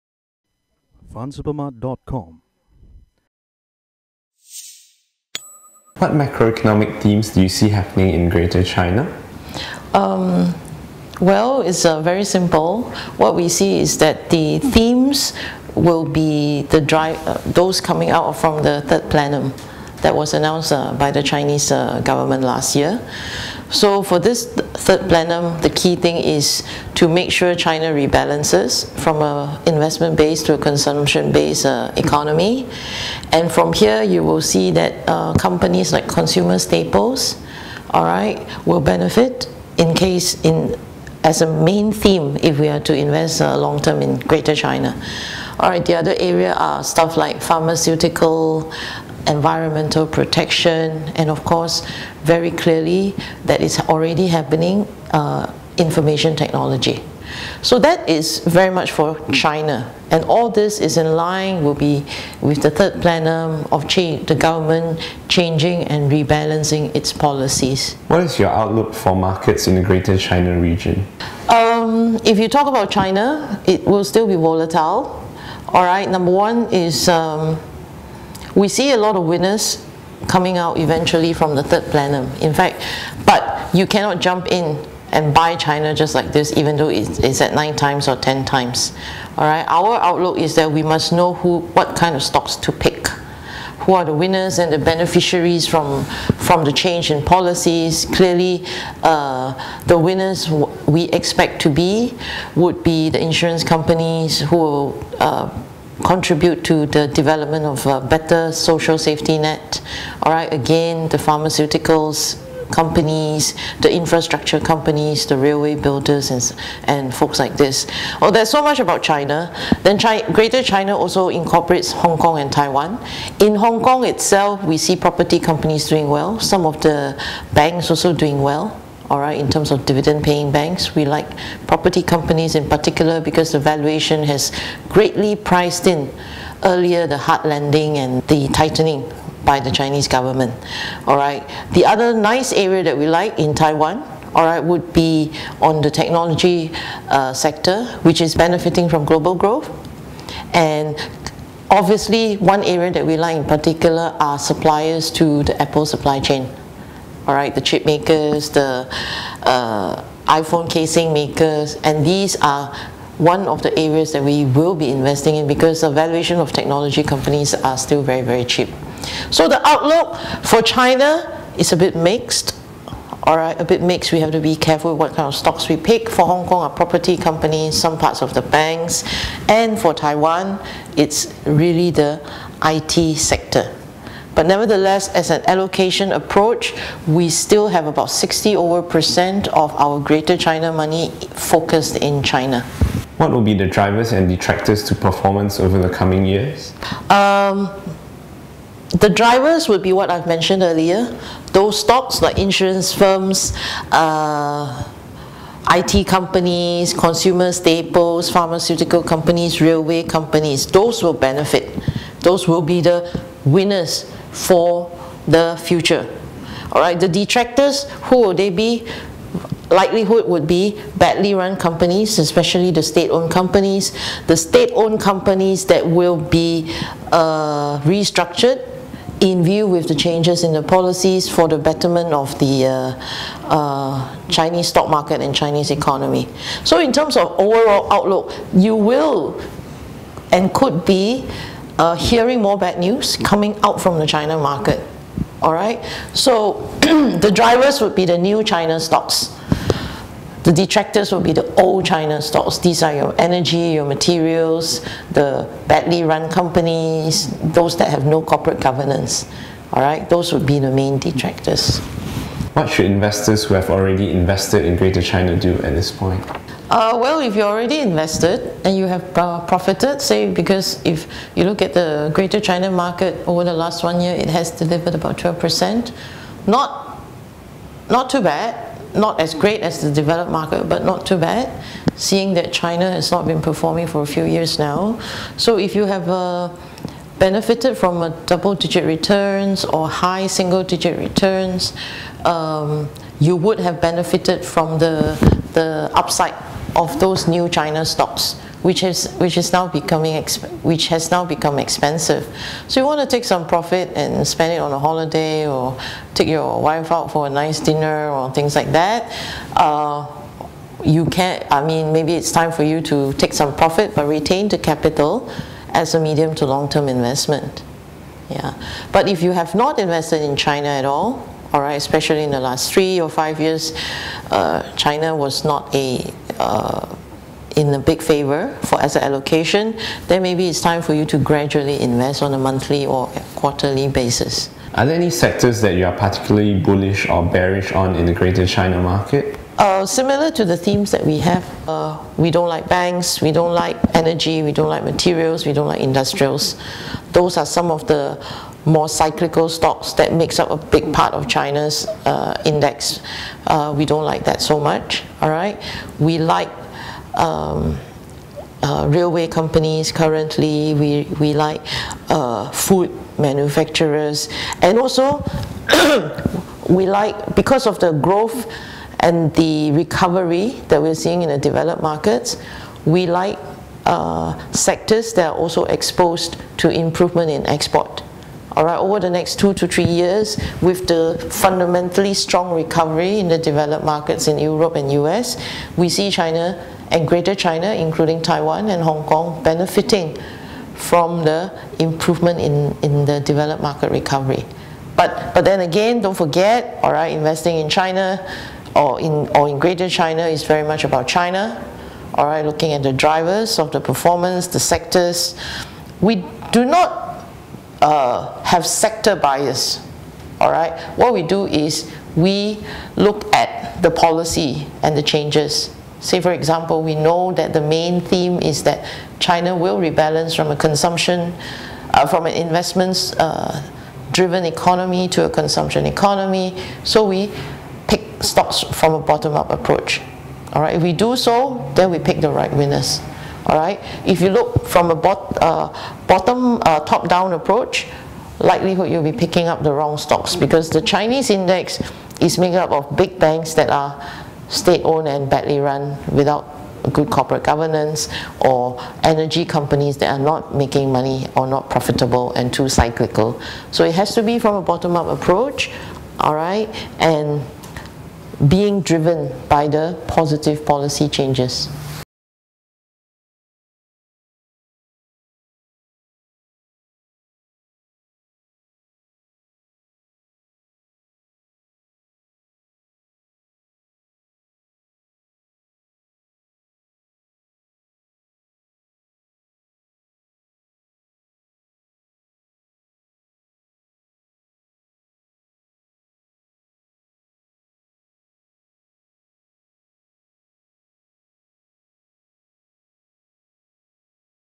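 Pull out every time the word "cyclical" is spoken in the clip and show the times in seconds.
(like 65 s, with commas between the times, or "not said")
348 s, 452 s.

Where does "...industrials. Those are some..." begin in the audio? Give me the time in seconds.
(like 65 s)
345 s.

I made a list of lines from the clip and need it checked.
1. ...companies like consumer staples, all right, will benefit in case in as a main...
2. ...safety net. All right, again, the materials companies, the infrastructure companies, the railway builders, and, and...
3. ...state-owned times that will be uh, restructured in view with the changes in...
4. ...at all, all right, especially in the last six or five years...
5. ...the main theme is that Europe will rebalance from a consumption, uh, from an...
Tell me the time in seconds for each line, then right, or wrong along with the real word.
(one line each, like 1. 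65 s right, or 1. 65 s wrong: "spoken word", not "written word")
1. 35 s right
2. 108 s wrong: "pharmaceuticals", not "materials"
3. 224 s wrong: "companies", not "times"
4. 320 s wrong: "three", not "six"
5. 417 s wrong: "China", not "Europe".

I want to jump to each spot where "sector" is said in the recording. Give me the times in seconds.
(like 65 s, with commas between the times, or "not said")
147 s, 183 s, 335 s, 374 s, 404 s, 408 s.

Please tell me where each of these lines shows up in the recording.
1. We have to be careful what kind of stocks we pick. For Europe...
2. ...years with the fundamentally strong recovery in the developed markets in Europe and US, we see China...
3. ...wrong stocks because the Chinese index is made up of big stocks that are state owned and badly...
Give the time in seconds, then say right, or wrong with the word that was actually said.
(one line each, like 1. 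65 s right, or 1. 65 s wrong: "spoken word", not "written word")
1. 174 s wrong: "Hong", not "Europe"
2. 379 s right
3. 439 s wrong: "banks", not "stocks".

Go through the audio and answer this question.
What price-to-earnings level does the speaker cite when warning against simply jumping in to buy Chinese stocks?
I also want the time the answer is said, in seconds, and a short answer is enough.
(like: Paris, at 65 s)
9 times or 10 times, at 87 s.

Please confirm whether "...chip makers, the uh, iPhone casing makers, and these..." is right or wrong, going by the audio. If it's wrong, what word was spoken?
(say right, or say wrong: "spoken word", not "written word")
right.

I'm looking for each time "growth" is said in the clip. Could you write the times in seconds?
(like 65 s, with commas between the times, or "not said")
149 s, 367 s.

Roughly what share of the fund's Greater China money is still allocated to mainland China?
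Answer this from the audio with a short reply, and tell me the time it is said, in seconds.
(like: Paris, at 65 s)
60 over percent, at 188 s.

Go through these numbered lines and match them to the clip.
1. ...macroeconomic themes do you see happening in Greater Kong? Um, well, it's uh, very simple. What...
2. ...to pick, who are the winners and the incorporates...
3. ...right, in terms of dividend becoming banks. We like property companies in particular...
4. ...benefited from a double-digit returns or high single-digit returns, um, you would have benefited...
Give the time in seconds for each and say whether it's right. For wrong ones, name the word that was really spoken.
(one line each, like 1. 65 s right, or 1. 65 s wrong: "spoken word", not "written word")
1. 6 s wrong: "China", not "Kong"
2. 92 s wrong: "beneficiaries", not "incorporates"
3. 129 s wrong: "paying", not "becoming"
4. 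287 s right.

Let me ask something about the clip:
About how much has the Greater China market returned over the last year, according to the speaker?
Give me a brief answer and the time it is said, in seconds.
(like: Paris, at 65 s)
12%, at 275 s.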